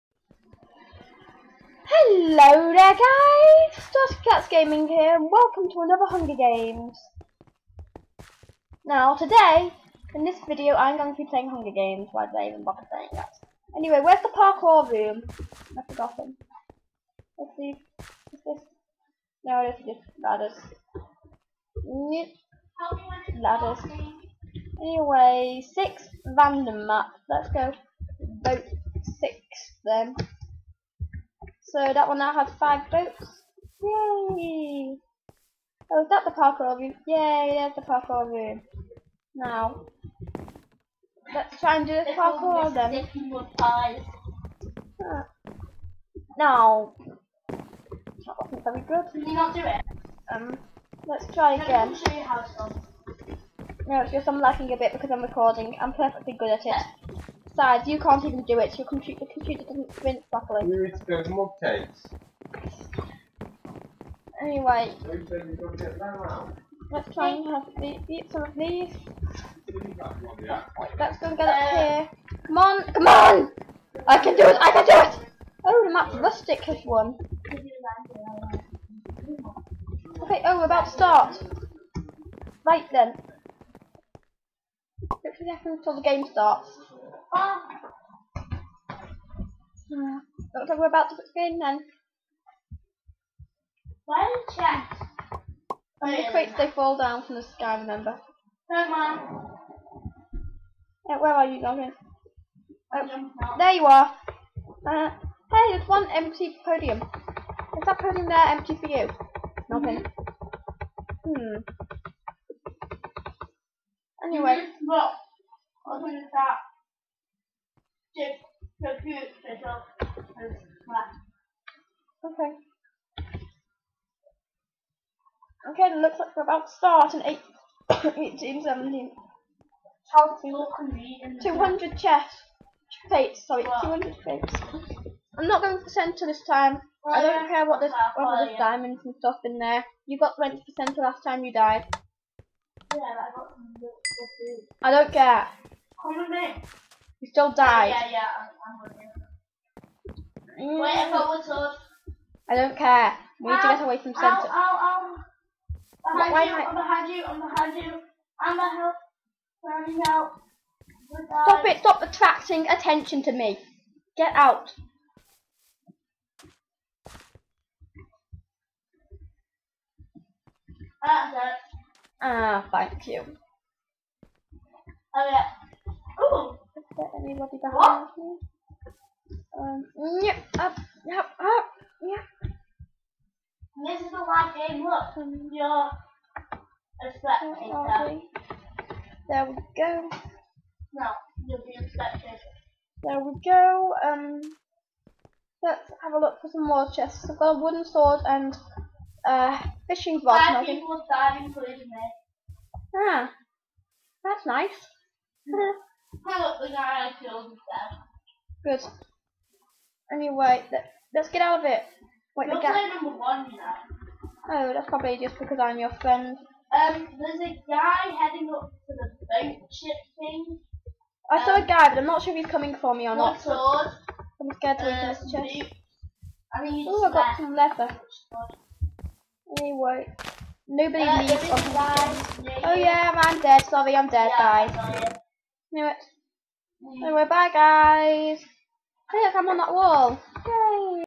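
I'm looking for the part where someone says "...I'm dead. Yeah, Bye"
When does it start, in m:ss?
3:53.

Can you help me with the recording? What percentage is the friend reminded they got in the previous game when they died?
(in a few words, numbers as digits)
20%.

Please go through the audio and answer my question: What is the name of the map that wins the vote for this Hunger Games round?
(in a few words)
Rustic.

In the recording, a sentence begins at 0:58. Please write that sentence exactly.
Your computer, your computer doesn't print properly.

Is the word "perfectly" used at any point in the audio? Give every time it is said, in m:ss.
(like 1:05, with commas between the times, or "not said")
0:55.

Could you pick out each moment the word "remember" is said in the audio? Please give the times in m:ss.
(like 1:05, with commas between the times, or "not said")
1:37.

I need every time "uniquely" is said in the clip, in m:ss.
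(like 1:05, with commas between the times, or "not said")
not said.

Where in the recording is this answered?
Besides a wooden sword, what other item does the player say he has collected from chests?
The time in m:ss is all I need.
3:19.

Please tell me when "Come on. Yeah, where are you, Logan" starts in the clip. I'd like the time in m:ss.
1:38.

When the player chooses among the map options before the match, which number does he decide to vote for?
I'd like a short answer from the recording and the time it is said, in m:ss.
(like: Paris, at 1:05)
6, at 0:28.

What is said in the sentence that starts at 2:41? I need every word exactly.
Stop it, stop attracting attention to me.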